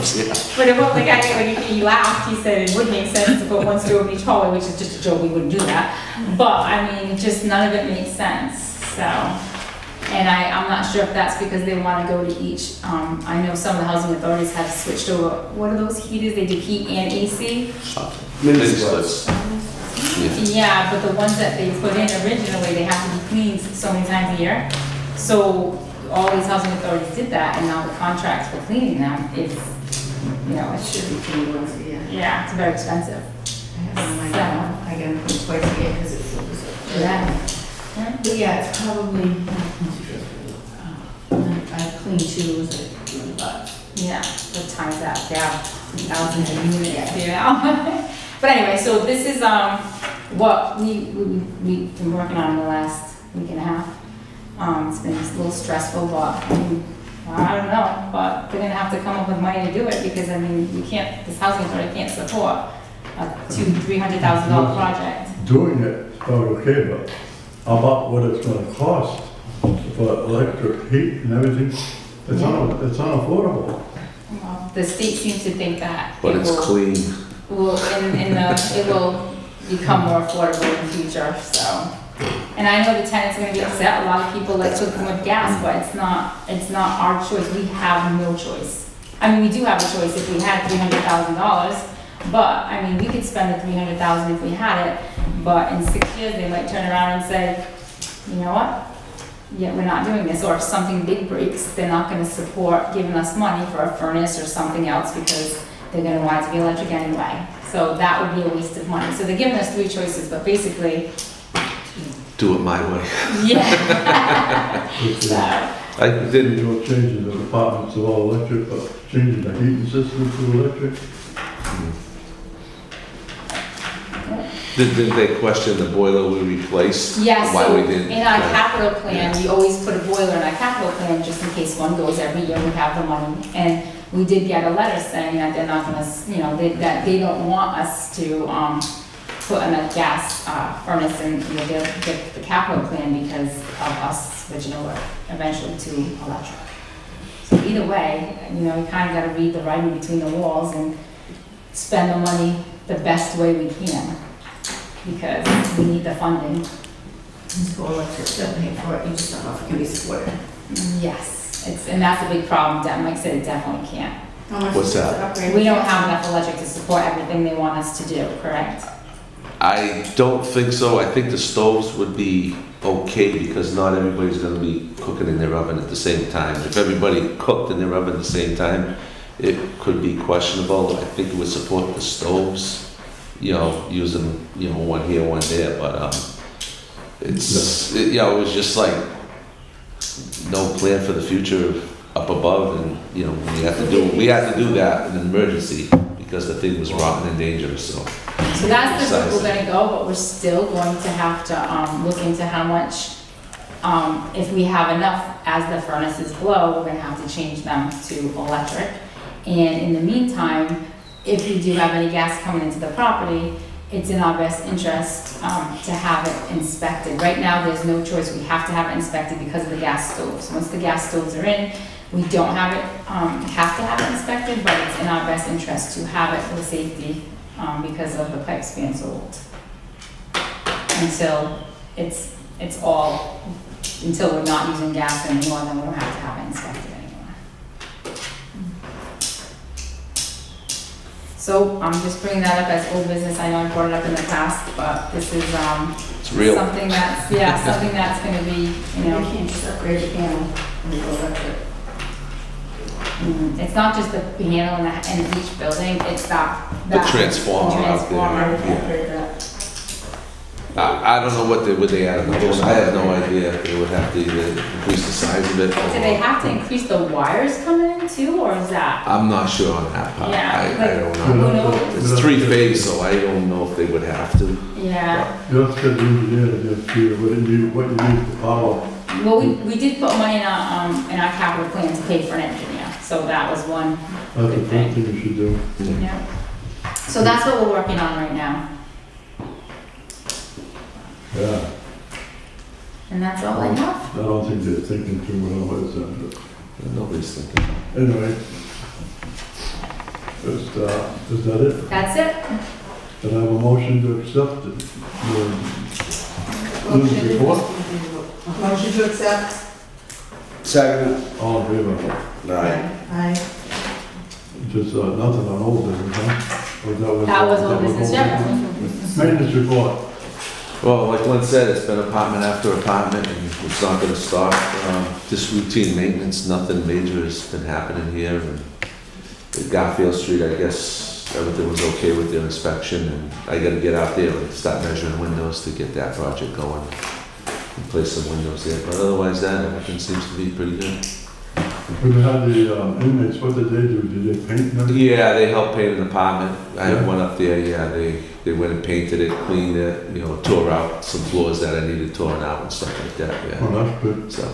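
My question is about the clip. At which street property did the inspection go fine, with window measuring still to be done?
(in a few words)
Garfield Street.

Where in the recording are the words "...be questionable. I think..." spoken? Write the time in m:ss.
3:00.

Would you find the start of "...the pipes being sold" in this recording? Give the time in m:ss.
3:48.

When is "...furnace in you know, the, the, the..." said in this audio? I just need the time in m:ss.
2:20.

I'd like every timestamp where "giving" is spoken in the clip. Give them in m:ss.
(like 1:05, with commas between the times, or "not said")
1:42, 1:49.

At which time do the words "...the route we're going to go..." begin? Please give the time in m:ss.
3:19.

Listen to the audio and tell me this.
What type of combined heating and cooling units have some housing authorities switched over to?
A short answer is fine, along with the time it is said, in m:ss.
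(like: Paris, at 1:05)
Mini splits, at 0:18.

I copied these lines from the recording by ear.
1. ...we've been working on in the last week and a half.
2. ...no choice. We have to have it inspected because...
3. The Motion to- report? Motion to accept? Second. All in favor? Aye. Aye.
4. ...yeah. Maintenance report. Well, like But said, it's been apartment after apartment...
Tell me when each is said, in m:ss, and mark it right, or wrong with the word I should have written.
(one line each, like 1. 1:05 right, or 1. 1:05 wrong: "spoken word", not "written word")
1. 0:51 right
2. 3:37 right
3. 5:05 right
4. 5:18 wrong: "Lynn", not "But".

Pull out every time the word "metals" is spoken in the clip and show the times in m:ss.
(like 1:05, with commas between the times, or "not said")
not said.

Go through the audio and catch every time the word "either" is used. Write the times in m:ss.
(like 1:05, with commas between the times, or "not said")
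2:27, 4:24.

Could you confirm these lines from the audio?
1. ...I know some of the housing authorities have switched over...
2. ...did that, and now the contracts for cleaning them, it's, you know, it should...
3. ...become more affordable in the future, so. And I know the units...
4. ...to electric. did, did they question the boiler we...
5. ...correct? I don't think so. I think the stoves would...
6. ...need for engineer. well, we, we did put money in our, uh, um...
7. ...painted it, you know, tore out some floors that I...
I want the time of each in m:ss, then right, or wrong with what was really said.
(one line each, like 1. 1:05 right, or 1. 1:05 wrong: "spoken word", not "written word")
1. 0:13 right
2. 0:27 right
3. 1:19 wrong: "tenants", not "units"
4. 2:00 right
5. 2:48 right
6. 4:38 wrong: "power", not "engineer"
7. 5:49 wrong: "cleaned", not "painted".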